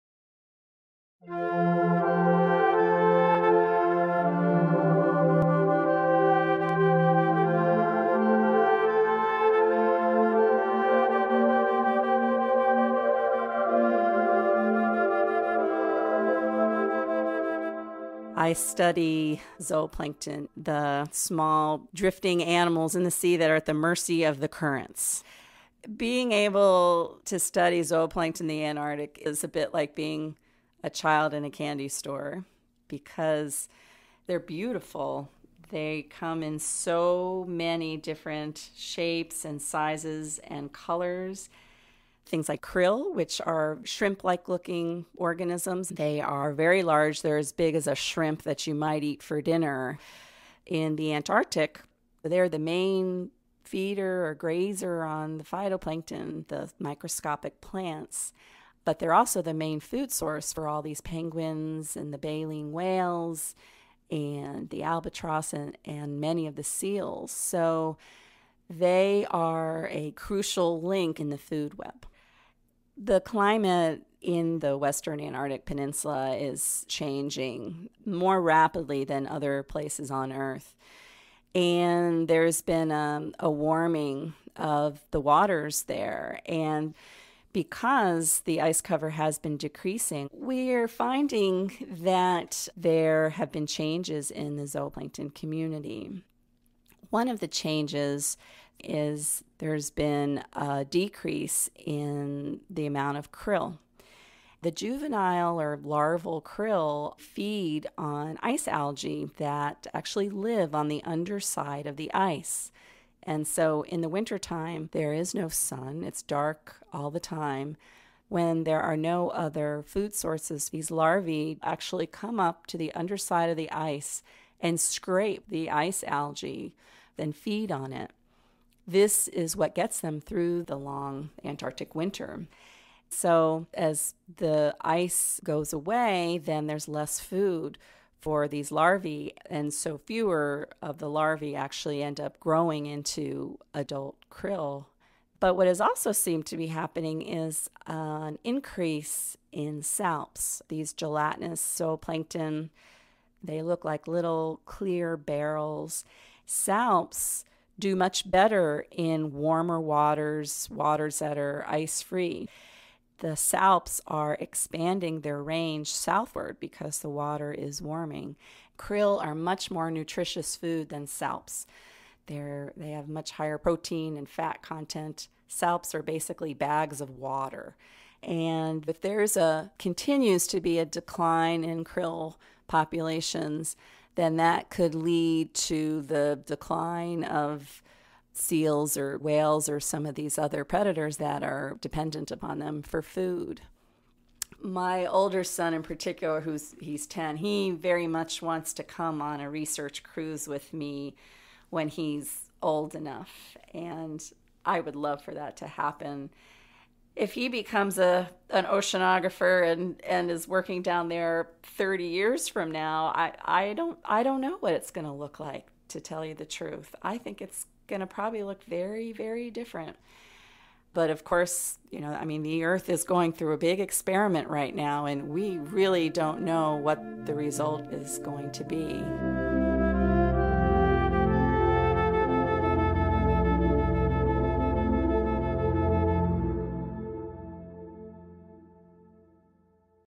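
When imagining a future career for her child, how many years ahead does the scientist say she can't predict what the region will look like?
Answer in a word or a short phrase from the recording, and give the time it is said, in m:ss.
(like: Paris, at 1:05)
30, at 3:31.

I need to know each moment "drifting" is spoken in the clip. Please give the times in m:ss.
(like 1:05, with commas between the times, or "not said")
0:21.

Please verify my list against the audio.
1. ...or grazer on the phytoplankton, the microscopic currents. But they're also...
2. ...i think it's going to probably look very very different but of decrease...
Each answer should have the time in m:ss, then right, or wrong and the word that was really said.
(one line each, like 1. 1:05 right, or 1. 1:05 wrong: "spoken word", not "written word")
1. 0:54 wrong: "plants", not "currents"
2. 3:37 wrong: "course", not "decrease".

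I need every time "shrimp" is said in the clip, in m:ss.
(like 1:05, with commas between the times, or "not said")
0:43, 0:47.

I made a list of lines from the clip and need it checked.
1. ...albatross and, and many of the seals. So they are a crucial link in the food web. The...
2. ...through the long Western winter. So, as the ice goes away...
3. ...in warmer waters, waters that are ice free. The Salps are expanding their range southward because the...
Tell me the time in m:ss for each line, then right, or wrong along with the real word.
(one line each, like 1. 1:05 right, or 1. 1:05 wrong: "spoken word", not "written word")
1. 1:04 right
2. 2:10 wrong: "Antarctic", not "Western"
3. 2:38 right.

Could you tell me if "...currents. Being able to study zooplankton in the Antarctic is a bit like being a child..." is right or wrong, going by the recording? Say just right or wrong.
right.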